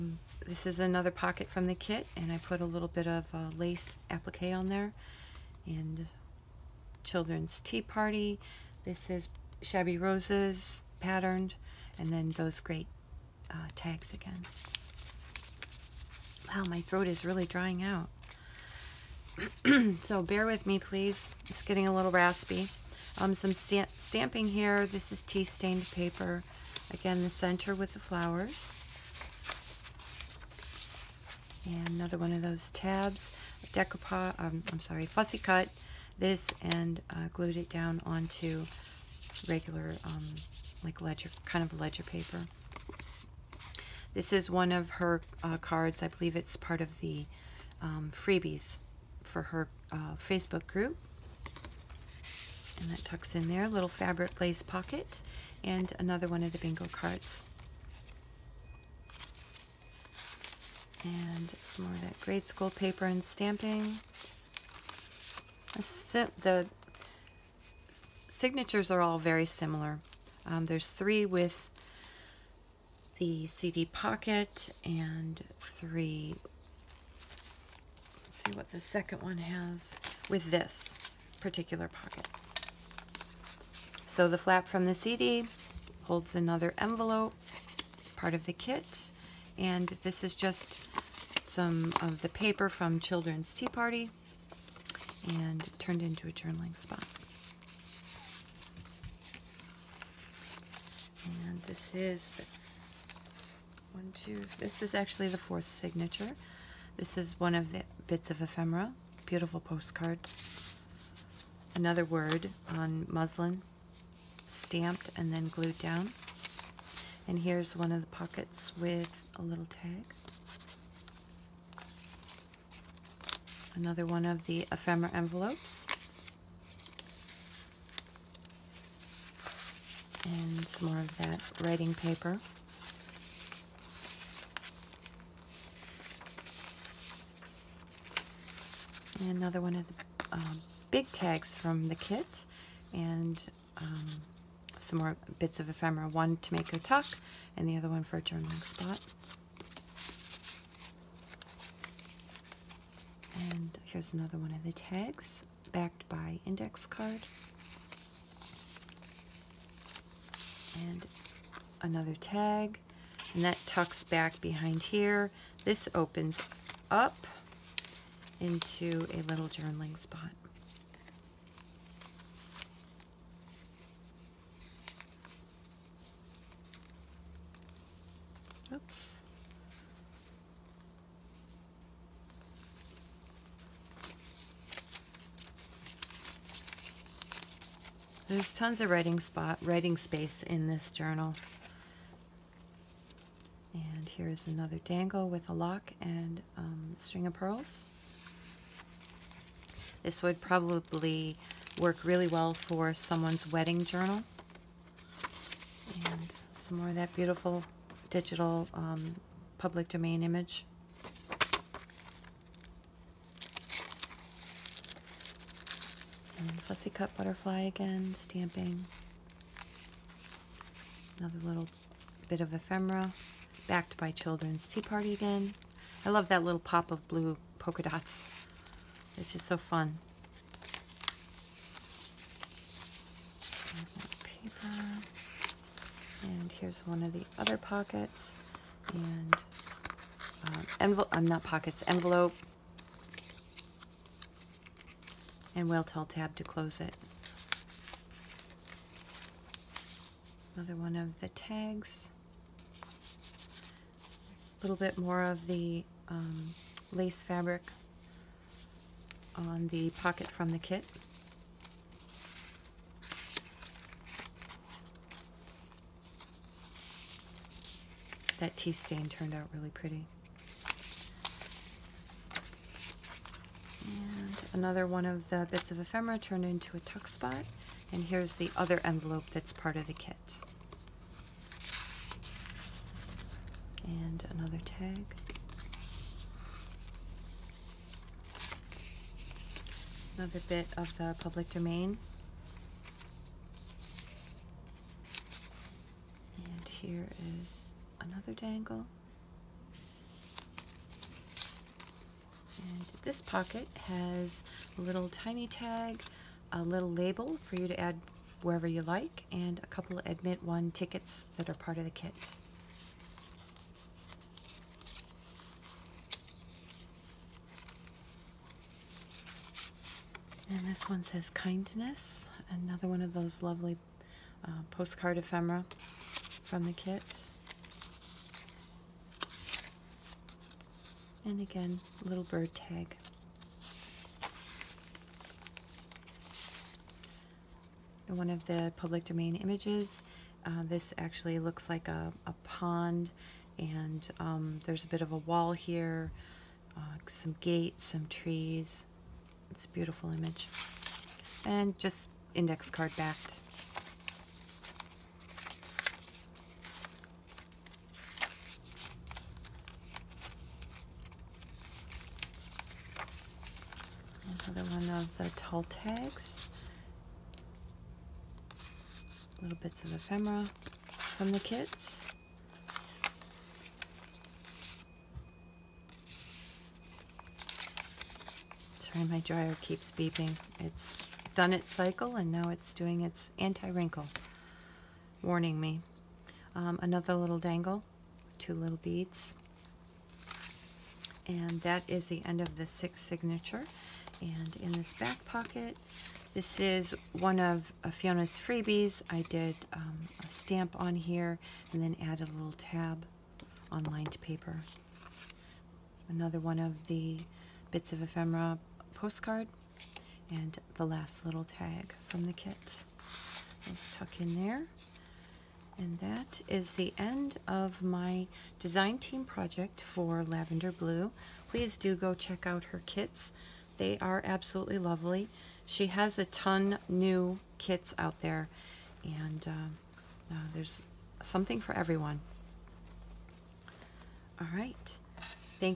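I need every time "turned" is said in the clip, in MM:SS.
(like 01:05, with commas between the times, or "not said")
01:35, 04:29, 04:36.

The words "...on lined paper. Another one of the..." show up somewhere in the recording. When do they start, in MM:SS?
06:43.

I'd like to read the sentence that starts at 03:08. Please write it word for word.
There's tons of writing spot, writing space in this journal.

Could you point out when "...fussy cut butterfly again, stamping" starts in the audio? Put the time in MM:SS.
03:36.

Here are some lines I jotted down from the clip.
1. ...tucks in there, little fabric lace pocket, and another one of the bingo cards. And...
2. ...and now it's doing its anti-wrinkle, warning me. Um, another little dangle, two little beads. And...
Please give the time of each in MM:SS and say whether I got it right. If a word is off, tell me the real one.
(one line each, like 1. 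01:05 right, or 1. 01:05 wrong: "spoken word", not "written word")
1. 00:53 right
2. 06:22 right.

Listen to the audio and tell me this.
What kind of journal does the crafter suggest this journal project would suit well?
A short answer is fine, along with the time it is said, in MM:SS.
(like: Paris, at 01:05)
wedding journal, at 03:23.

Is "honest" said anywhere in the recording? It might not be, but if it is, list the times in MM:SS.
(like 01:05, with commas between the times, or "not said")
not said.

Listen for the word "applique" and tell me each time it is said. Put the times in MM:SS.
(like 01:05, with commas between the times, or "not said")
00:04.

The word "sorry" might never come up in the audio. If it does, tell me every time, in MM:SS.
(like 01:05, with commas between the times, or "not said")
00:34, 06:18.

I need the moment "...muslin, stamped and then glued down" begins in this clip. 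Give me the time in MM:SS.
01:53.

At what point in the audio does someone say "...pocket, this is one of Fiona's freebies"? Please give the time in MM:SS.
06:35.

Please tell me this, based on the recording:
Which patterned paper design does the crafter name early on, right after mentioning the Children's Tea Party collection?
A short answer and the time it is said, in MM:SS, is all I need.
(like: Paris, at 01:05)
Shabby Roses, at 00:09.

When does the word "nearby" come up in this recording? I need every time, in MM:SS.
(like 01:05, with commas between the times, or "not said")
not said.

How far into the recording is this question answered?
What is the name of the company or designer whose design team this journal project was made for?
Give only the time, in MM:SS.
07:00.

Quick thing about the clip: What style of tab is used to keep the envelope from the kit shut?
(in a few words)
whale tail tab.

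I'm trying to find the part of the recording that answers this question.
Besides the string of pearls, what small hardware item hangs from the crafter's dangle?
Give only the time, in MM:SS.
03:15.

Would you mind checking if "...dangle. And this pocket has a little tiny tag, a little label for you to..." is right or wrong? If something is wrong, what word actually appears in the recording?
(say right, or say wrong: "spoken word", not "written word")
right.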